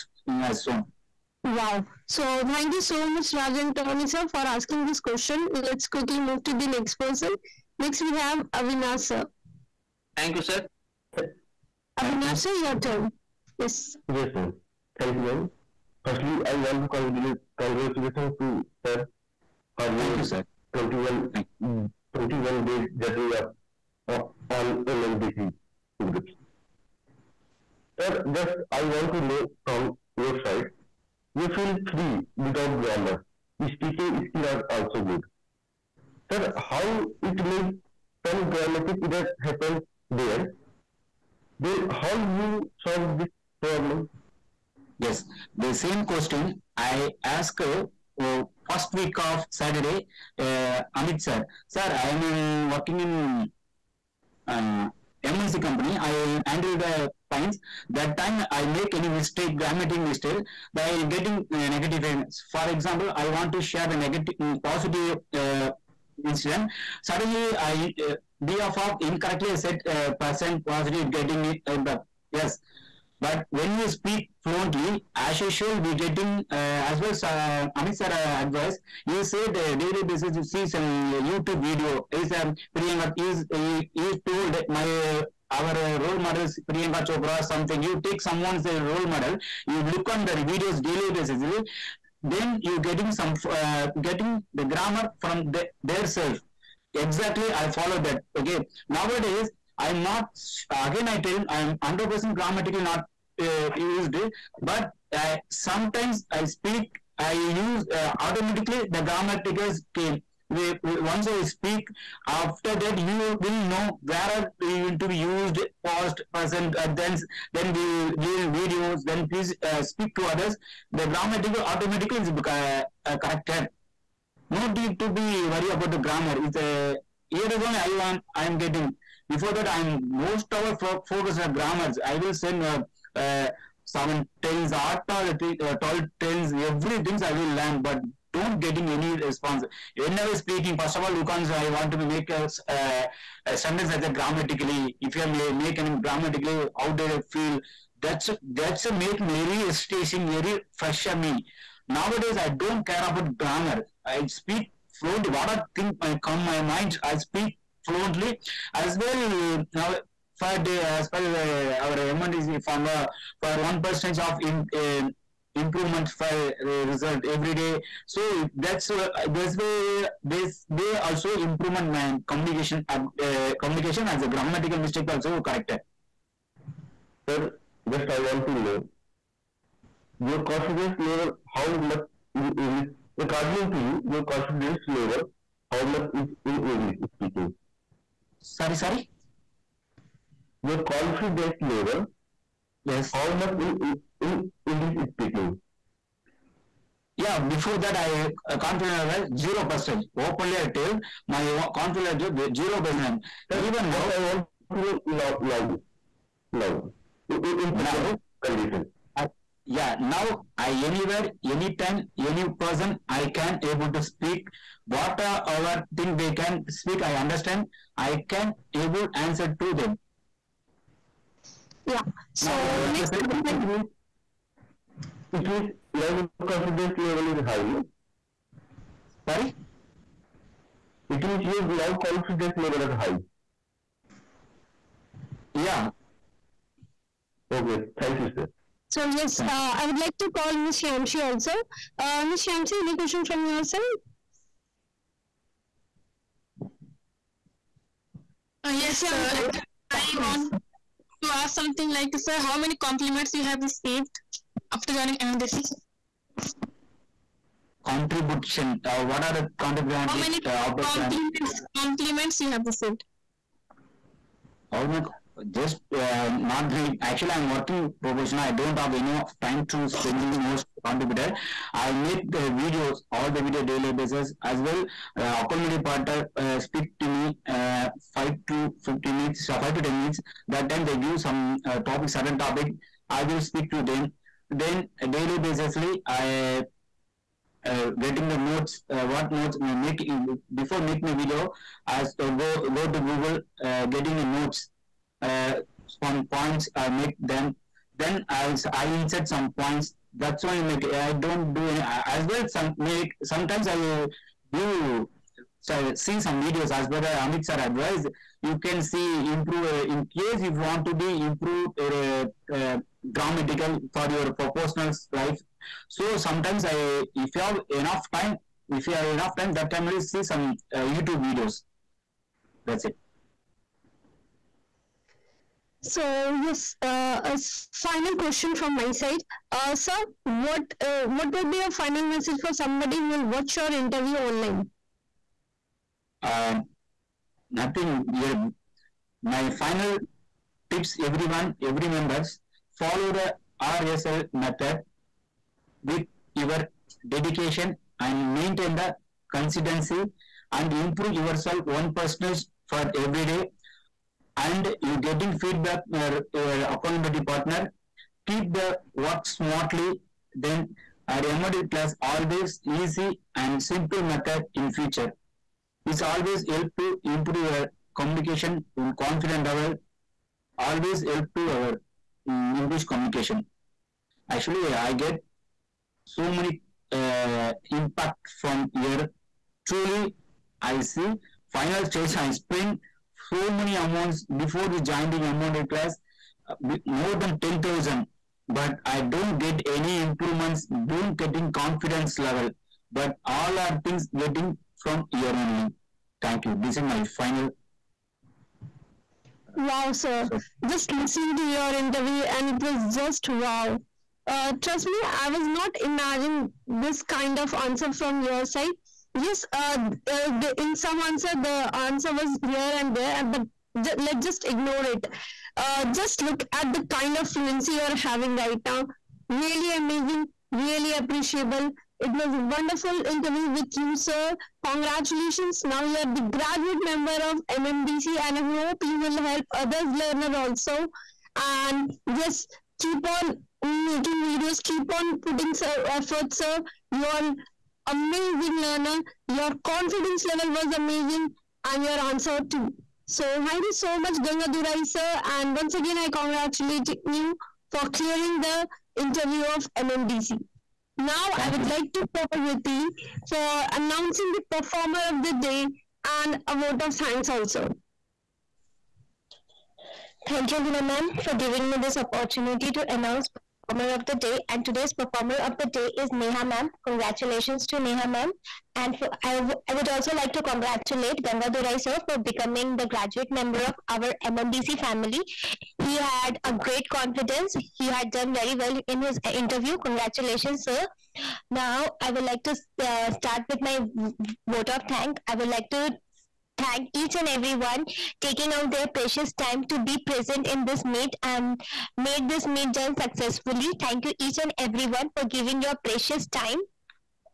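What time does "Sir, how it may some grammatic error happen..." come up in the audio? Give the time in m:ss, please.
0:36.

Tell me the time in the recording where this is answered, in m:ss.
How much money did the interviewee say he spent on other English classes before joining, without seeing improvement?
6:26.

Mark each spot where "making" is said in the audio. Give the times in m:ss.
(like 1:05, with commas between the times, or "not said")
4:50, 7:13.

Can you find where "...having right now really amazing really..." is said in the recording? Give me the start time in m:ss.
6:57.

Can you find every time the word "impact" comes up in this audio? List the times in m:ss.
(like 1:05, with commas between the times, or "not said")
1:11, 6:17.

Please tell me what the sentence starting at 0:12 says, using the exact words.
sir your turn yes yes ma'am Thank you, ma'am.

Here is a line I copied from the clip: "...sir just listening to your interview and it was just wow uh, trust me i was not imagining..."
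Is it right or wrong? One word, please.
right.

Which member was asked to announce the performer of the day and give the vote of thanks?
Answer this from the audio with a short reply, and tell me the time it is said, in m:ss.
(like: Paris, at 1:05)
Riti, at 7:32.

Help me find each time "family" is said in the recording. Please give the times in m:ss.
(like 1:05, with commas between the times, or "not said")
7:54.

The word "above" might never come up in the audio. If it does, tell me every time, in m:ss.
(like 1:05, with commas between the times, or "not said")
not said.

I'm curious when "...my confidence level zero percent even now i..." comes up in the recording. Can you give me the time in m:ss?
3:21.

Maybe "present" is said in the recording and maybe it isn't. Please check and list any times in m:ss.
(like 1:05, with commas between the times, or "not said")
1:56, 3:27, 8:09.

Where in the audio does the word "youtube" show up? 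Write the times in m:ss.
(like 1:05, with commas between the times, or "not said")
1:21, 5:20.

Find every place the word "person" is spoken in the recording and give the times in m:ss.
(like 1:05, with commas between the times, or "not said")
0:06, 3:32.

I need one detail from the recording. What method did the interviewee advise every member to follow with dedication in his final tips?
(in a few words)
RSL method.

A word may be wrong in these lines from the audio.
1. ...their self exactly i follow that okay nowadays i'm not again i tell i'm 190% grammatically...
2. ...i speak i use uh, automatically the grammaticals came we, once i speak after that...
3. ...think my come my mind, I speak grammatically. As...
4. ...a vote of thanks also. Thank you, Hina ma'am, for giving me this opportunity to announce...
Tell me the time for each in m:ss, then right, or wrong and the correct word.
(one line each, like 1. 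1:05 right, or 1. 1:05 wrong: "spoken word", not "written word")
1. 1:35 wrong: "100", not "190"
2. 1:46 right
3. 2:35 wrong: "fluently", not "grammatically"
4. 7:36 right.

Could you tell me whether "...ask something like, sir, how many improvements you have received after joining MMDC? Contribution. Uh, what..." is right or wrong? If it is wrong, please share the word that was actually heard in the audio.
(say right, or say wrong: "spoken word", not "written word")
wrong: "compliments", not "improvements".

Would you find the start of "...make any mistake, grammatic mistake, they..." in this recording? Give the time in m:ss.
0:58.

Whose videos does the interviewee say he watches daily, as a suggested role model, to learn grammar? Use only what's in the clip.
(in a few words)
Priyanka Chopra.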